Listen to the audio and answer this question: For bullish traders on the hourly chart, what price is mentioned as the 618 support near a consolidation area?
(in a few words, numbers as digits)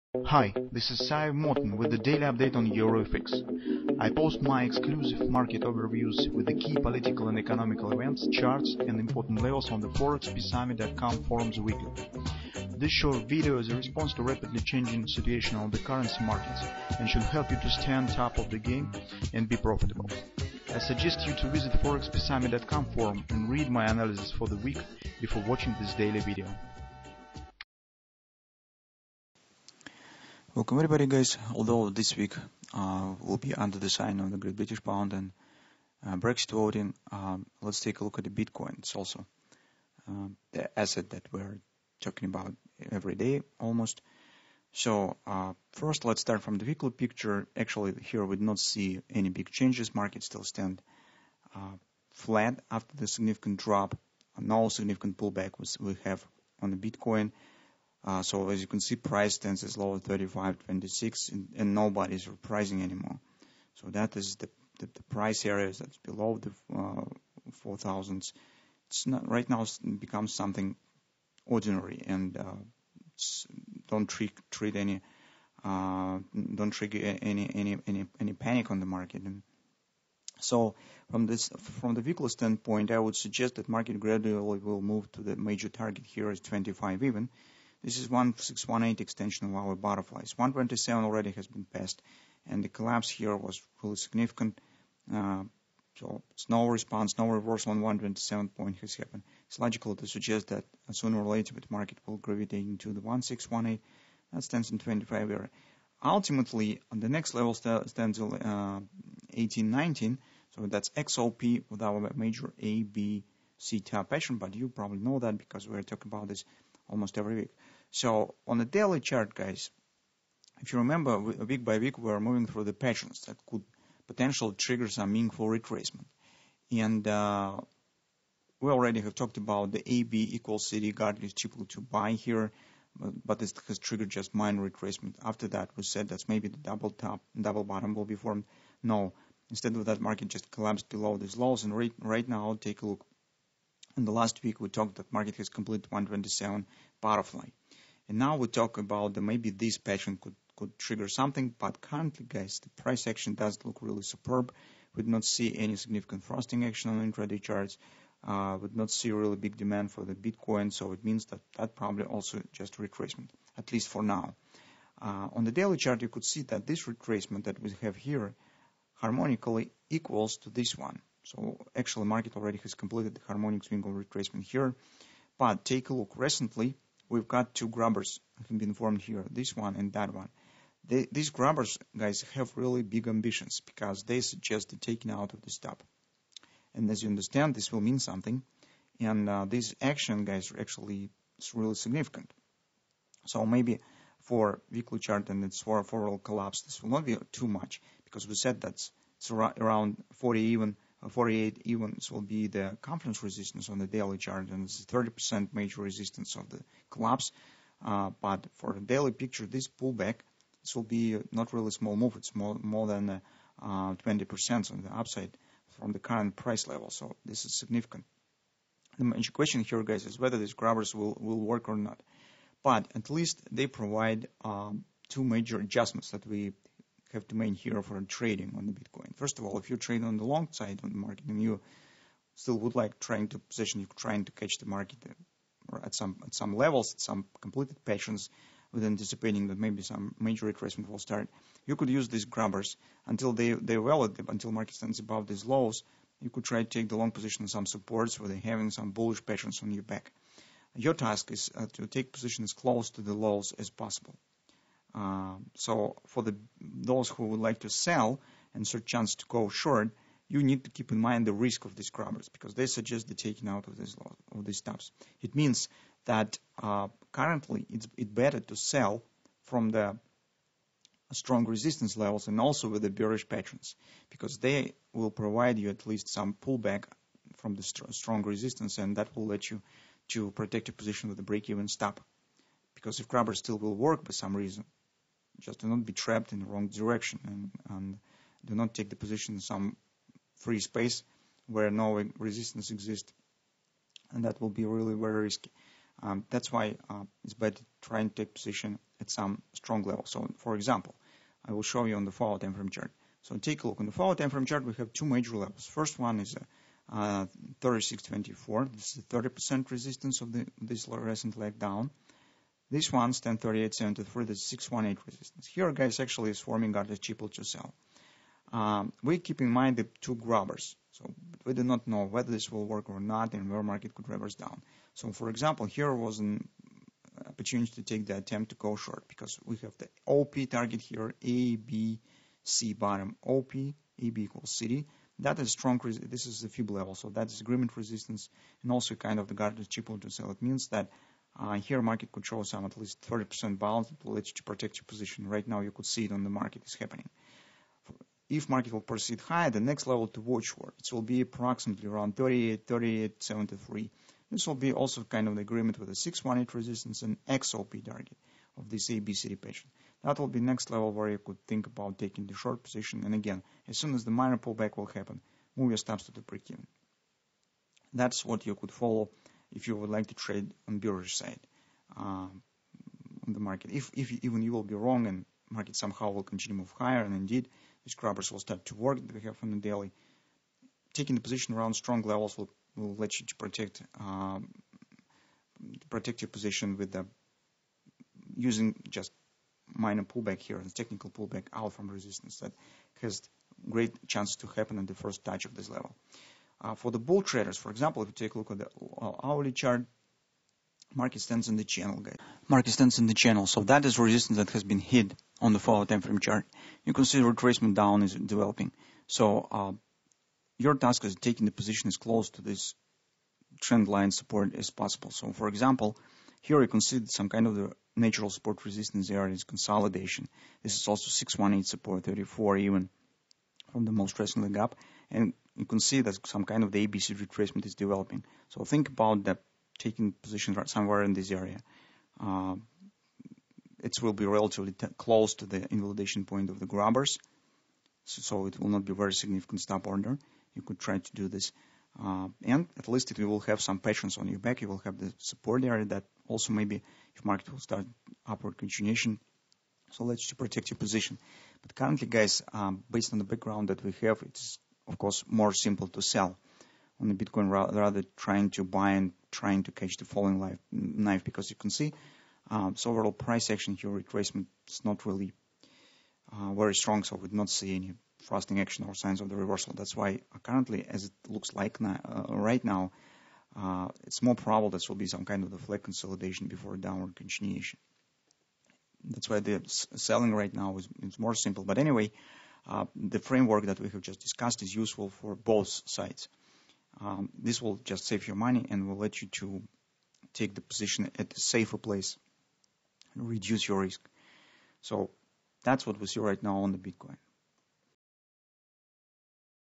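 34.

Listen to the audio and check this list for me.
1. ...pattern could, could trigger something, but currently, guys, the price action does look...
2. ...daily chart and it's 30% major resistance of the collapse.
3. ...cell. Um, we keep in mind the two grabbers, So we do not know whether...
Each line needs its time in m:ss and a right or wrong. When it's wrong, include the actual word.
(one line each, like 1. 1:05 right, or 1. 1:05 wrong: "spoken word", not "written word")
1. 2:29 right
2. 3:23 right
3. 5:17 right.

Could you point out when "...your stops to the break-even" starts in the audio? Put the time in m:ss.
6:05.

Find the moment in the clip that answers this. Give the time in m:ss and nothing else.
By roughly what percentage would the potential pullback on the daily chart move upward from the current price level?
3:32.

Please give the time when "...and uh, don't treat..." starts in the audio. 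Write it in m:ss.
1:12.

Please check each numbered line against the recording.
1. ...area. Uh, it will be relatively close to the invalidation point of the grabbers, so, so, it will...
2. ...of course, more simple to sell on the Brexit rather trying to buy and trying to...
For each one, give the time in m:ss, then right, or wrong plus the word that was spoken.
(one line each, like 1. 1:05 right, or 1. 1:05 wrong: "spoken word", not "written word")
1. 7:11 right
2. 7:34 wrong: "Bitcoin", not "Brexit".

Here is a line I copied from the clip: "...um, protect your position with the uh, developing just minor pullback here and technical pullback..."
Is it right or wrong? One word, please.
wrong.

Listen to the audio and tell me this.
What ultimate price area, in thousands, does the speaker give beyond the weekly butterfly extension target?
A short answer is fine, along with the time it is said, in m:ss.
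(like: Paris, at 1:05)
1819, at 1:48.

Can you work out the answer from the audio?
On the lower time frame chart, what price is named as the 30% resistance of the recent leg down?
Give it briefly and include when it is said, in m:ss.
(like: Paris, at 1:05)
36.24, at 5:07.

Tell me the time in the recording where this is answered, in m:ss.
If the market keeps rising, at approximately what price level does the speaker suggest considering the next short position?
5:52.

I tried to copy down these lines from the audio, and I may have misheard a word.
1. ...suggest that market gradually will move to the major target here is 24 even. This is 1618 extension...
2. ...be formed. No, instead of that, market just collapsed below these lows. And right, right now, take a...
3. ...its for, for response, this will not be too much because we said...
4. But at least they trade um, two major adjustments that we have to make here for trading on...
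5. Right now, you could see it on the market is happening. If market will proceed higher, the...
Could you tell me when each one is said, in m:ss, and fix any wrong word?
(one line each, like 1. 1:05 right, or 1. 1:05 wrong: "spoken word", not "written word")
1. 1:23 wrong: "25", not "24"
2. 2:18 right
3. 3:15 wrong: "collapse", not "response"
4. 3:42 wrong: "provide", not "trade"
5. 5:45 right.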